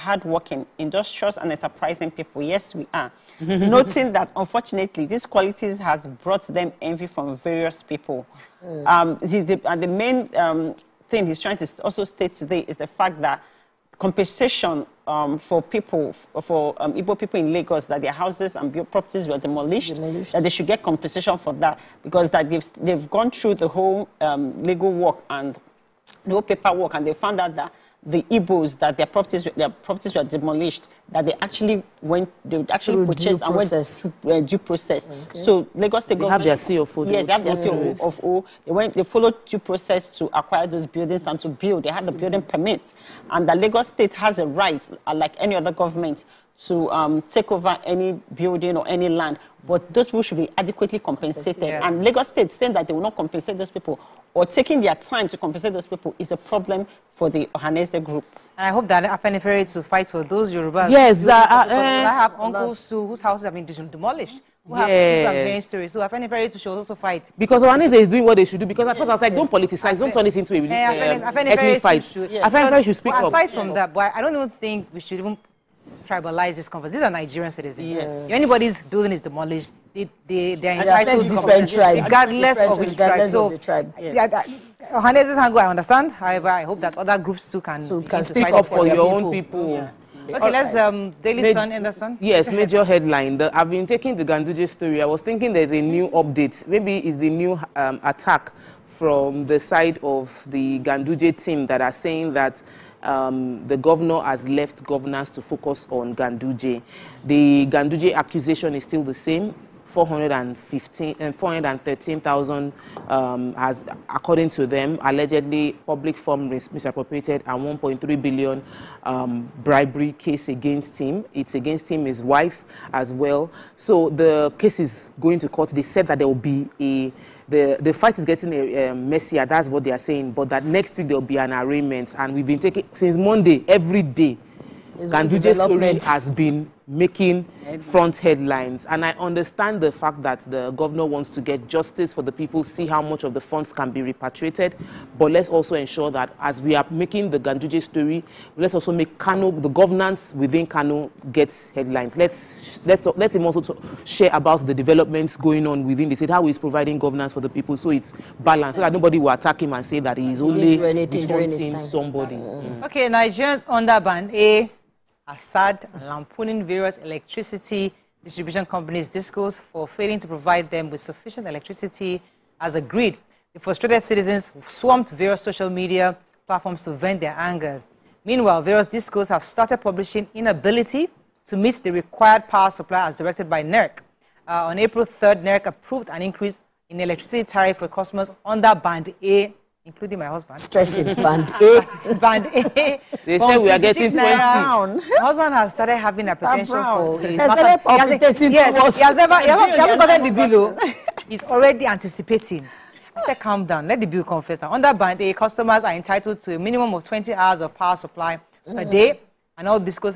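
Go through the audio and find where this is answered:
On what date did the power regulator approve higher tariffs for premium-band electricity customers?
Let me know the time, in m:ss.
3:04.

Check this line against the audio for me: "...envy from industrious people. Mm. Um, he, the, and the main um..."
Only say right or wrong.
wrong.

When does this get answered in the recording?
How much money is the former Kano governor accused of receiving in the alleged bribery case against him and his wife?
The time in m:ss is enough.
1:57.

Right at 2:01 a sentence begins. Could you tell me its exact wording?
It's against him, his wife as well.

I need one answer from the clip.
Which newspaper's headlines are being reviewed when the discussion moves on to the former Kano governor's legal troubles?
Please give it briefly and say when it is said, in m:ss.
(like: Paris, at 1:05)
Daily Sun, at 1:31.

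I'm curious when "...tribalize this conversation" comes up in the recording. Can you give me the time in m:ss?
1:16.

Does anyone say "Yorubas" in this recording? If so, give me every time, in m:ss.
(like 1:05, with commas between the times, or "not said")
1:00.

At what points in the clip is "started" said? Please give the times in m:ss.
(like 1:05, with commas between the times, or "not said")
2:59, 3:15.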